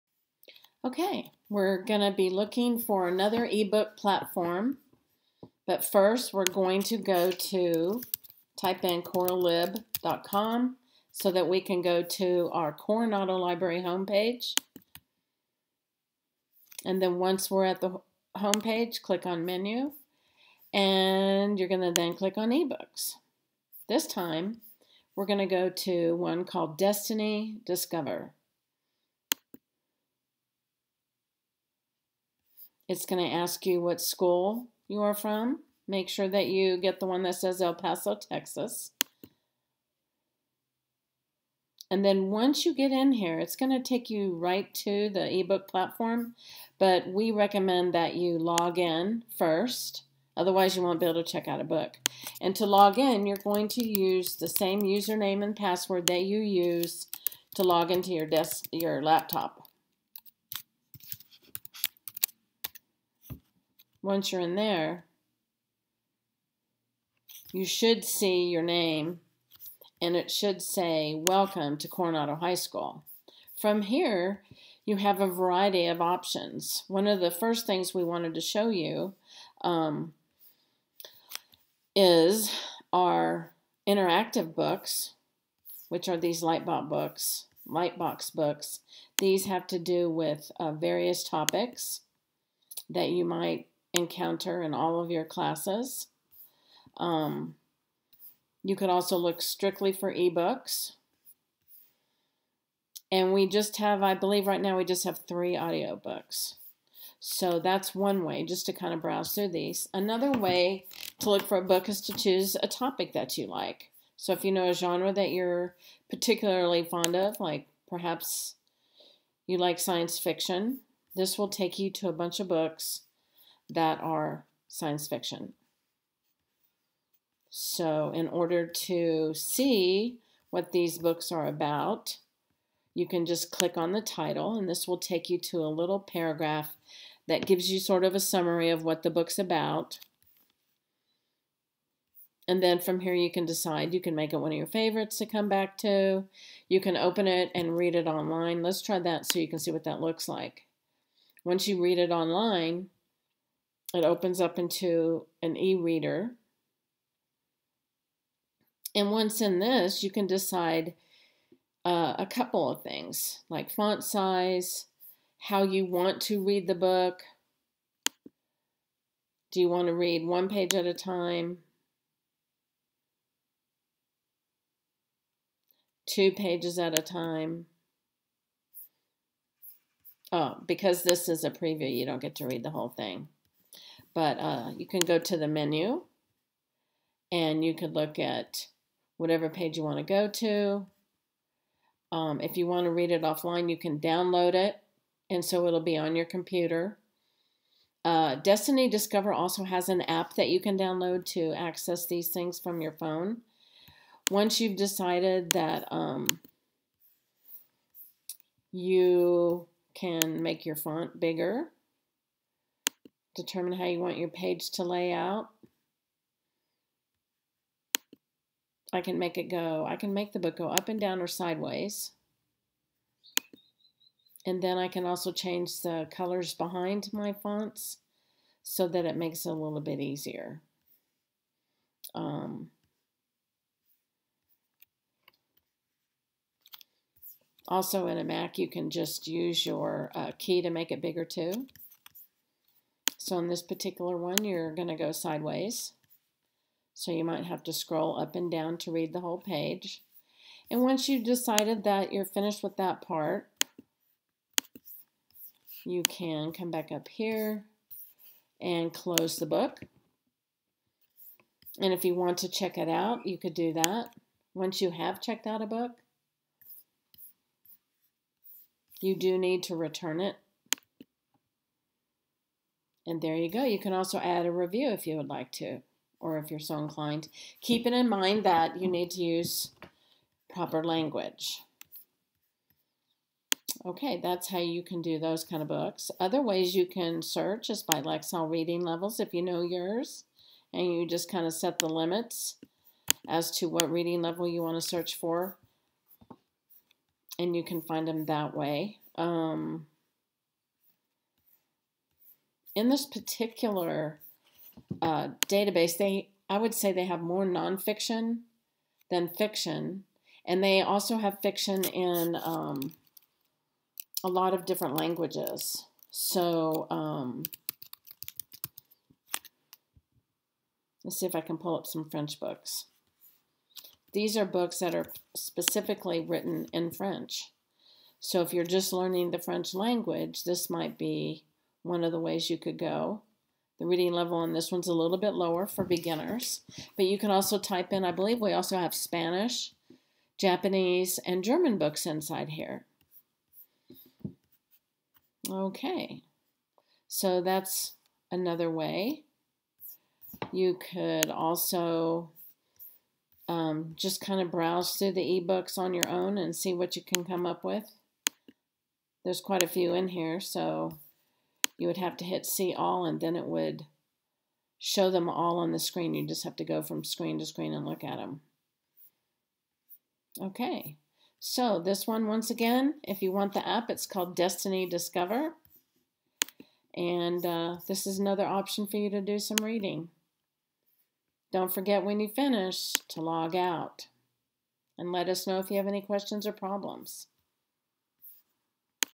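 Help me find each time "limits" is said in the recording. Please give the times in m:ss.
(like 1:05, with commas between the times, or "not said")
4:51.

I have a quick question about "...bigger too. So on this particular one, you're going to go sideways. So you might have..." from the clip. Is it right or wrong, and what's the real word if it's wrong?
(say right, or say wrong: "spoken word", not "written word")
right.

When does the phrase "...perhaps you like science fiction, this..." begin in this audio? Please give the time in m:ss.
1:57.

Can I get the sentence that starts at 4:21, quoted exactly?
And if you want to check it out, you could do that.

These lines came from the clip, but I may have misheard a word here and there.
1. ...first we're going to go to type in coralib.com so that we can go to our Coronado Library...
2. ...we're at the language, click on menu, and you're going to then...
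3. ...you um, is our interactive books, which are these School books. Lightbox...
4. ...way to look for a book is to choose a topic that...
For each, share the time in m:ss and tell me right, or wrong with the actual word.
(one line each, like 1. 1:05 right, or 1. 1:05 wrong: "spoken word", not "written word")
1. 0:05 right
2. 0:17 wrong: "homepage", not "language"
3. 1:18 wrong: "Lightbox", not "School"
4. 1:50 right.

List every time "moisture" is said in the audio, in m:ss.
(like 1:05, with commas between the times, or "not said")
not said.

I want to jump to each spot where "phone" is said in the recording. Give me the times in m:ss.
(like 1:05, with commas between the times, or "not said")
3:22.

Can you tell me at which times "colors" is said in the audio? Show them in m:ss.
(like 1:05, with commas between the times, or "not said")
3:46.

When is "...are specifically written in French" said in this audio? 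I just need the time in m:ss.
5:24.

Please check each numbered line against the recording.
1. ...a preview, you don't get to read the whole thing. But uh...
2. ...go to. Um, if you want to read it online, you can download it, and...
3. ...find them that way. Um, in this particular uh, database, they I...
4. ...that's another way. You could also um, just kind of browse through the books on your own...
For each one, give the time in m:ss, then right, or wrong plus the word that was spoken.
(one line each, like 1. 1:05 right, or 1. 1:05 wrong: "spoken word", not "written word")
1. 3:01 right
2. 3:10 wrong: "offline", not "online"
3. 4:57 right
4. 5:47 wrong: "ebooks", not "books".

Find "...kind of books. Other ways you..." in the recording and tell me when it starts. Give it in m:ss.
4:45.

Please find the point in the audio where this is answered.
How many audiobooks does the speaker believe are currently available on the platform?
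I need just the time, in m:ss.
1:45.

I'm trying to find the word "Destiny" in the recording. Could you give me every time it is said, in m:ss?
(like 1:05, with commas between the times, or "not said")
0:26, 3:18, 6:14.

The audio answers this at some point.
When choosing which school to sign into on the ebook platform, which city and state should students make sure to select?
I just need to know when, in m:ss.
0:37.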